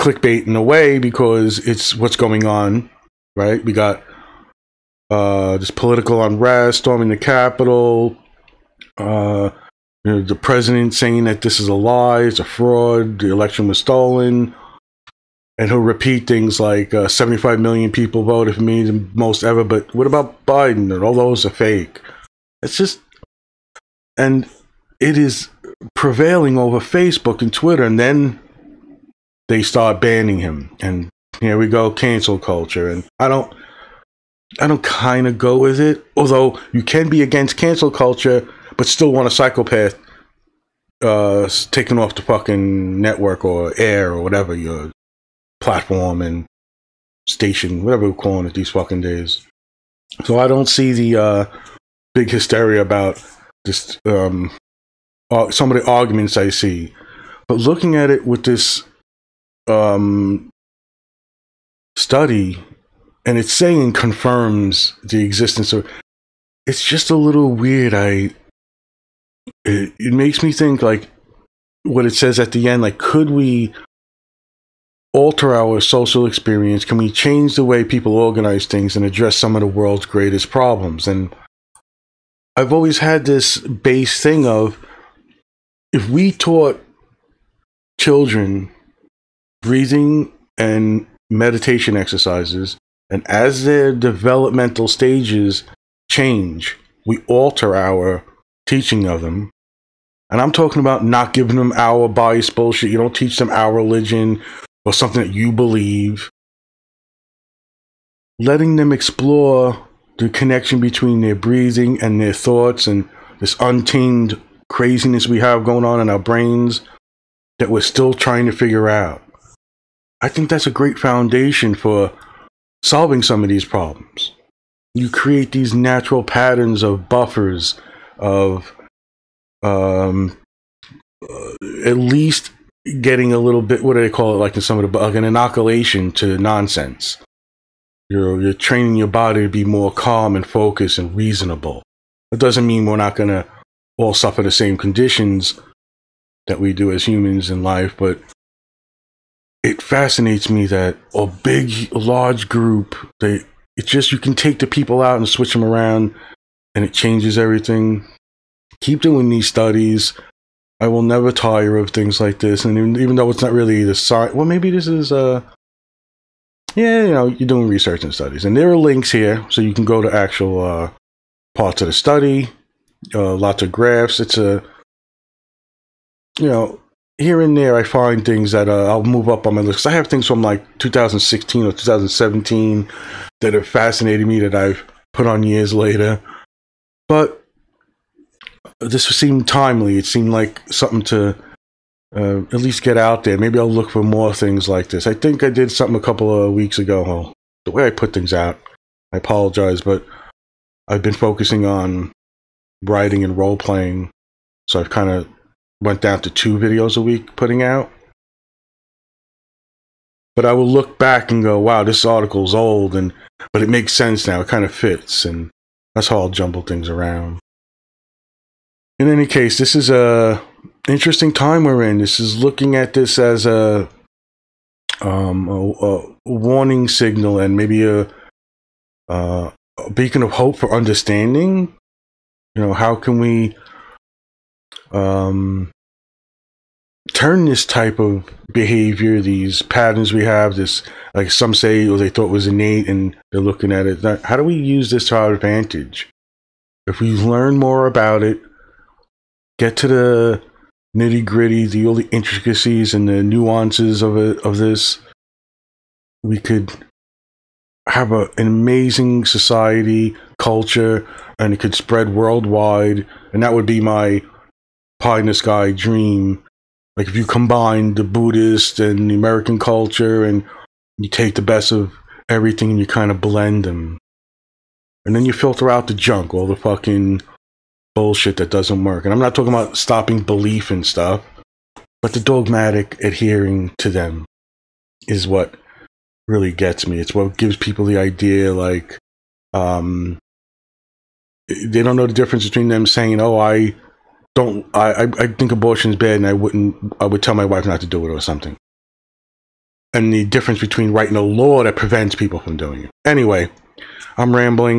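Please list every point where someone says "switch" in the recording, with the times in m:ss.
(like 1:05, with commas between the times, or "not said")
2:35.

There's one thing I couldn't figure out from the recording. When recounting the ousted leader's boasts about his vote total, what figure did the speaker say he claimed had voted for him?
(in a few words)
75 million.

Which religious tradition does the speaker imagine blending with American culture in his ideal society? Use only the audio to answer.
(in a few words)
Buddhist.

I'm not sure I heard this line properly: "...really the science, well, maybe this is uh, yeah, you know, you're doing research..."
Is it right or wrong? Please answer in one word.
right.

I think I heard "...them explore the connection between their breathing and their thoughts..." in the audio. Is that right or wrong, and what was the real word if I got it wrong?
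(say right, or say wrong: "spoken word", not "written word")
right.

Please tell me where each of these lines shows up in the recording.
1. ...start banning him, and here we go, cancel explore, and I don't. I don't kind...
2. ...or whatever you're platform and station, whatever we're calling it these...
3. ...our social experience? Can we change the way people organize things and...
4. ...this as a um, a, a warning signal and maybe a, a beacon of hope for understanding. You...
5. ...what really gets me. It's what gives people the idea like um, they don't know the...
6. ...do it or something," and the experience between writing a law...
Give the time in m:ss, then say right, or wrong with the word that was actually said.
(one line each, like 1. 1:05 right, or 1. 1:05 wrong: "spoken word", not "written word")
1. 0:29 wrong: "culture", not "explore"
2. 0:44 right
3. 1:15 right
4. 3:42 right
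5. 4:45 right
6. 4:57 wrong: "difference", not "experience".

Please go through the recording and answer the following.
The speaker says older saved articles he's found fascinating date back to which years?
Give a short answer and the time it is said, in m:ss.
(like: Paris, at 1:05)
2016 or 2017, at 3:00.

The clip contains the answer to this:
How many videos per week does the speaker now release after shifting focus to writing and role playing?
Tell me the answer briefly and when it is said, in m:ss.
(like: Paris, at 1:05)
2, at 3:26.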